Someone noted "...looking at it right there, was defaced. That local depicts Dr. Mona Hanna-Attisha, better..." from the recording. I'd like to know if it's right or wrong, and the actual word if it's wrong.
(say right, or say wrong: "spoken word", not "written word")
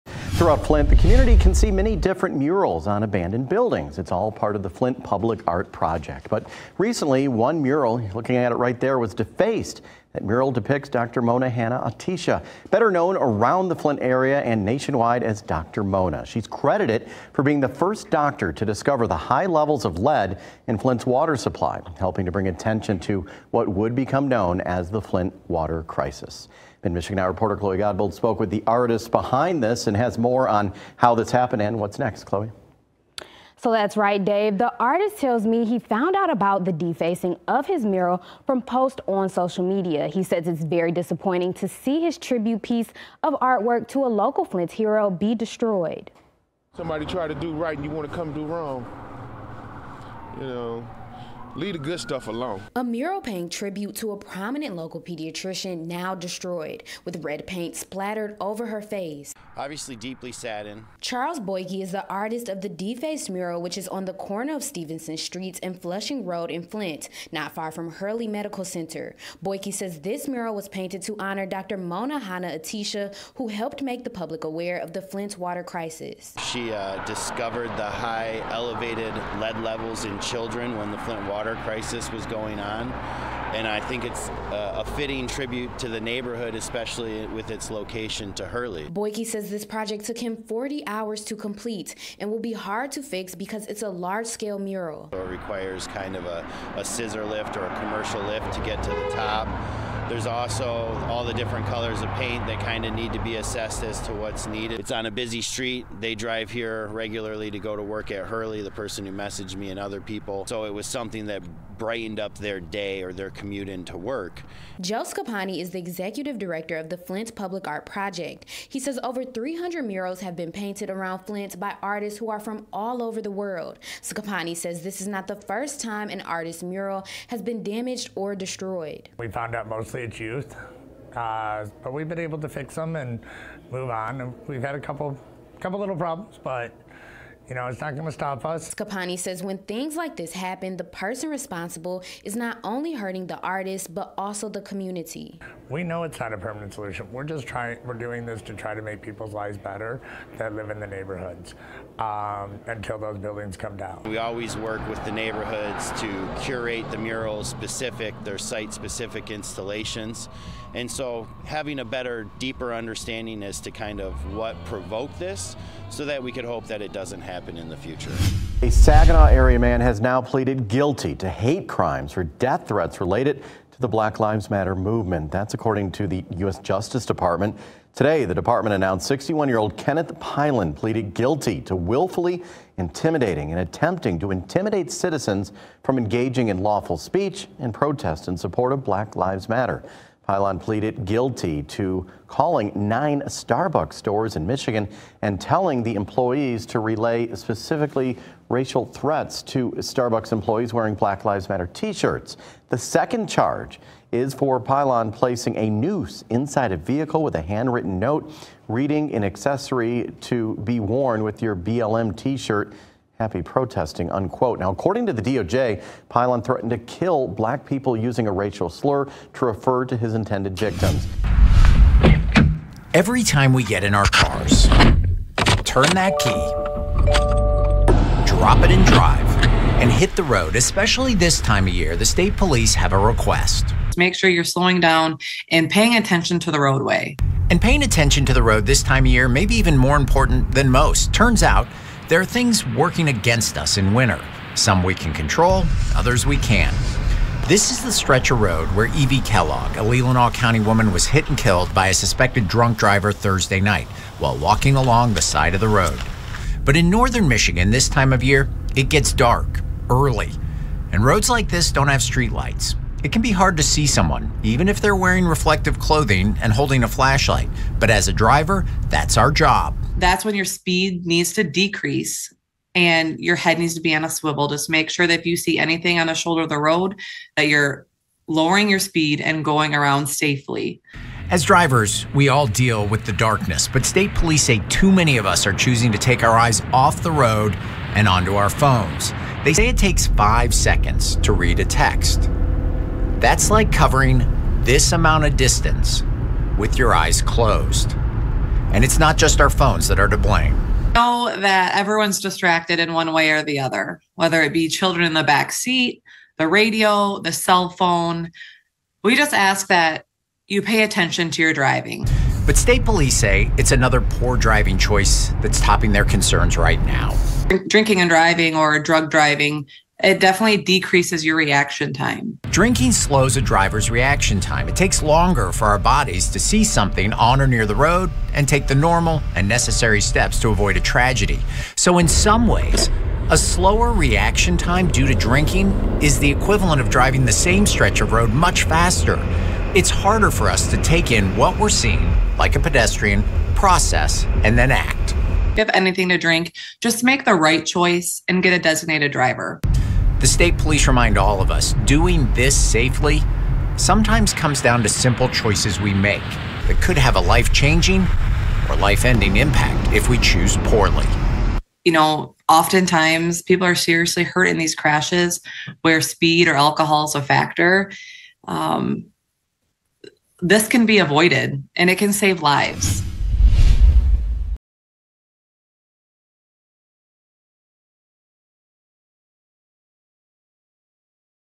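wrong: "mural", not "local".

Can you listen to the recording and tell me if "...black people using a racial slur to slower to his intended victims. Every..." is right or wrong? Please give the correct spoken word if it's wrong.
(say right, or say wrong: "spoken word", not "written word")
wrong: "refer", not "slower".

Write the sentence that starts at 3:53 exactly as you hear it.
Make sure you're slowing down and paying attention to the roadway.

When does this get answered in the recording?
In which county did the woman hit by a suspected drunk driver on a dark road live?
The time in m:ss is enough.
4:09.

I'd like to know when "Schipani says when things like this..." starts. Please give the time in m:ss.
2:18.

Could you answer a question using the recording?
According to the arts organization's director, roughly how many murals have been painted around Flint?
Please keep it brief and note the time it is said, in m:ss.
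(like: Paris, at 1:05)
over 300, at 1:59.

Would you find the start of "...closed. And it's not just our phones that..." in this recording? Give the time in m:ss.
4:57.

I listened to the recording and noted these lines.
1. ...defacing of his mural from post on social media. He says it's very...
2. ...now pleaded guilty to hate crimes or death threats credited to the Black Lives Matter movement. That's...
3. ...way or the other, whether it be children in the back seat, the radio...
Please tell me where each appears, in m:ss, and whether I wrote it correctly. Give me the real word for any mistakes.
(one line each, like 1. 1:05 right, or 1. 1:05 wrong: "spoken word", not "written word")
1. 0:36 right
2. 2:50 wrong: "related", not "credited"
3. 5:03 right.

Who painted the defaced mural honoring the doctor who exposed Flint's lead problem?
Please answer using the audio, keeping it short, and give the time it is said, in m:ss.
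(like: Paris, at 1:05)
Charles Boike, at 1:01.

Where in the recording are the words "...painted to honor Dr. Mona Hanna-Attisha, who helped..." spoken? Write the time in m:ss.
1:10.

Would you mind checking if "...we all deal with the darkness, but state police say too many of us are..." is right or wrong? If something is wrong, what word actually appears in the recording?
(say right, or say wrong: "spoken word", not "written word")
right.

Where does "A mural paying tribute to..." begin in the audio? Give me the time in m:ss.
0:52.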